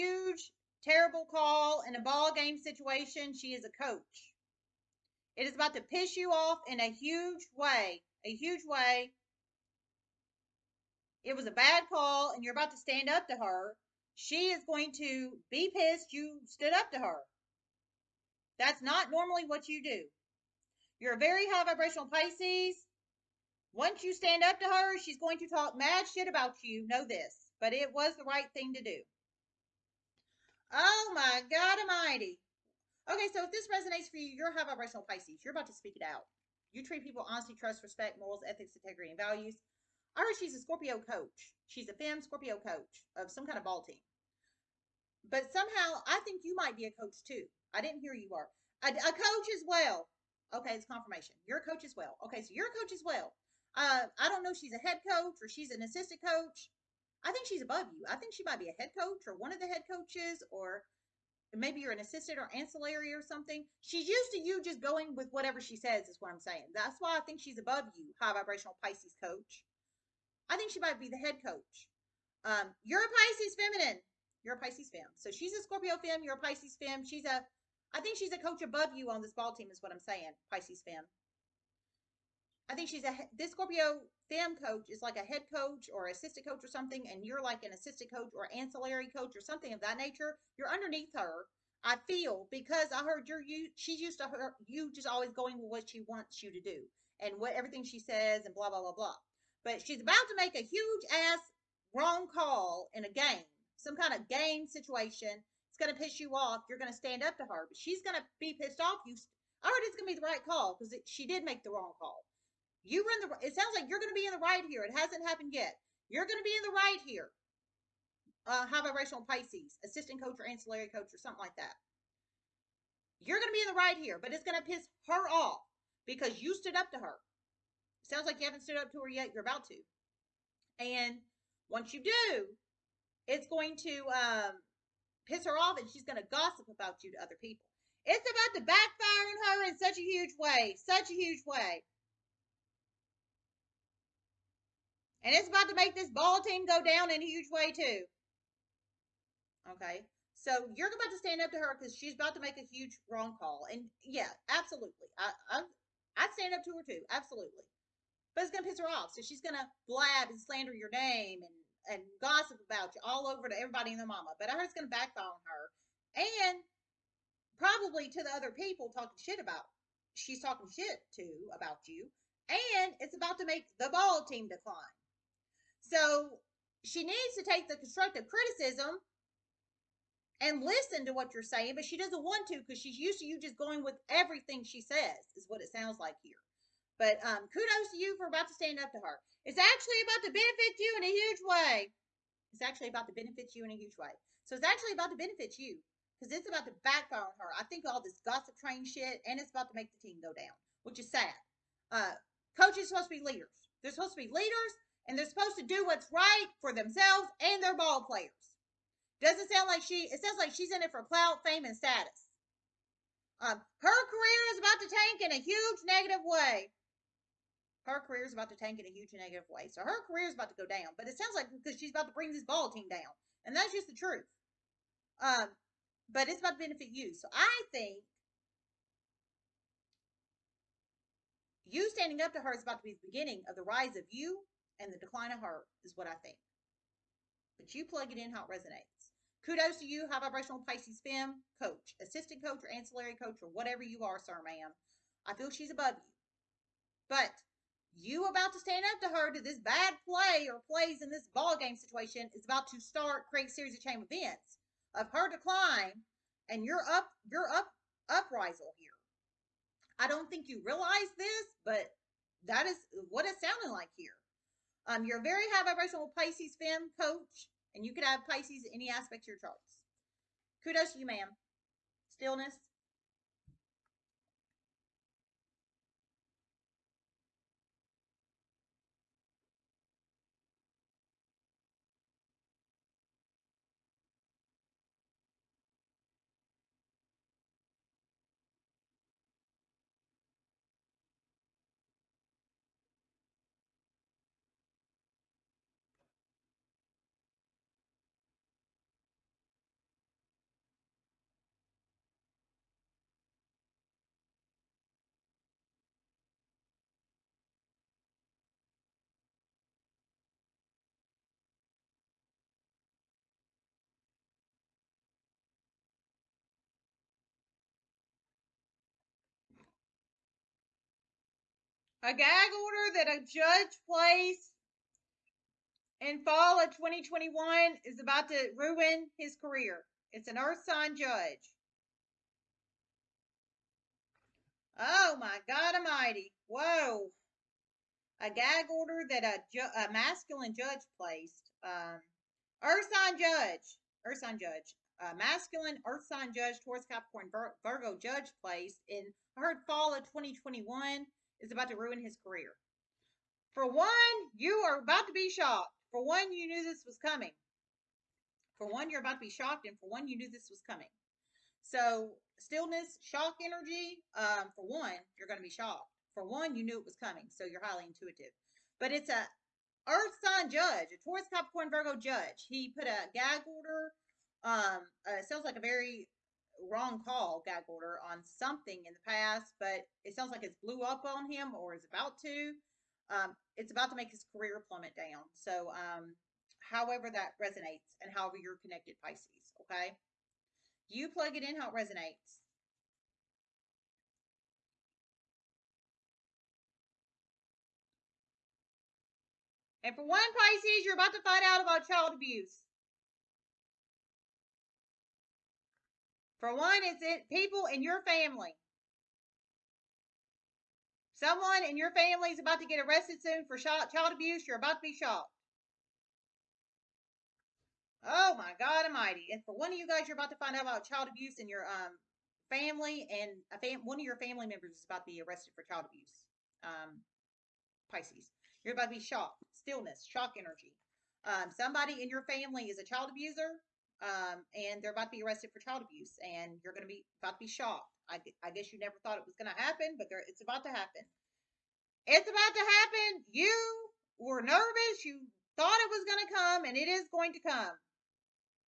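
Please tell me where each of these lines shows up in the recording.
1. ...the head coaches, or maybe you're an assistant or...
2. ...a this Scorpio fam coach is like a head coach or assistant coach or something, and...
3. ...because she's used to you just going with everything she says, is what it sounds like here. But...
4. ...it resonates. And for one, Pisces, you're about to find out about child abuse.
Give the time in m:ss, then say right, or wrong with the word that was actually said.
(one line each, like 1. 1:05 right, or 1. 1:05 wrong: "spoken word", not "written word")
1. 0:59 right
2. 1:23 right
3. 3:02 right
4. 6:31 right.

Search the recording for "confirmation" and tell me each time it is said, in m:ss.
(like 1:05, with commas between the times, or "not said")
0:50.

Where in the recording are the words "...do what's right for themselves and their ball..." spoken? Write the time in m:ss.
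3:25.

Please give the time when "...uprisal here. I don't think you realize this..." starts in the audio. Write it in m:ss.
4:18.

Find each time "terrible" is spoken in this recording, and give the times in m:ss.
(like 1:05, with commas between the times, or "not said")
0:00.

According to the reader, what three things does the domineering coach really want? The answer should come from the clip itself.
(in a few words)
clout, fame, and status.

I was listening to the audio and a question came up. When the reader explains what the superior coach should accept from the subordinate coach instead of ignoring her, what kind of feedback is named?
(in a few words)
constructive criticism.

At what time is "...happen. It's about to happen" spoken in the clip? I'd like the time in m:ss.
7:20.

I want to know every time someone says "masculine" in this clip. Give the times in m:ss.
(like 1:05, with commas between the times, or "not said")
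5:39, 5:45.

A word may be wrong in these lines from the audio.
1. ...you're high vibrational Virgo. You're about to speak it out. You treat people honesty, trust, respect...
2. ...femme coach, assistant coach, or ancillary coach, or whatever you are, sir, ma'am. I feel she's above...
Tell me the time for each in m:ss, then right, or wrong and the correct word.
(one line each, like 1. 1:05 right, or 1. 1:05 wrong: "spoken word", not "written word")
1. 0:34 wrong: "Pisces", not "Virgo"
2. 4:01 right.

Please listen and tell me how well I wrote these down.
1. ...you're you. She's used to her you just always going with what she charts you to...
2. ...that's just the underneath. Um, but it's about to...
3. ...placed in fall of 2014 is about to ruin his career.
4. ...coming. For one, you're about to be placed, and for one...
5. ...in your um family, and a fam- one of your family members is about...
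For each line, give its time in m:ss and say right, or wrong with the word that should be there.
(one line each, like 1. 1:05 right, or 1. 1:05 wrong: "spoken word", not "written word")
1. 1:33 wrong: "wants", not "charts"
2. 3:43 wrong: "truth", not "underneath"
3. 5:23 wrong: "2021", not "2014"
4. 5:57 wrong: "shocked", not "placed"
5. 7:01 right.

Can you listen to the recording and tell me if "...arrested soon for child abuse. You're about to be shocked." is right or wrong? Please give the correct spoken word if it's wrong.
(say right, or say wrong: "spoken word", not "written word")
right.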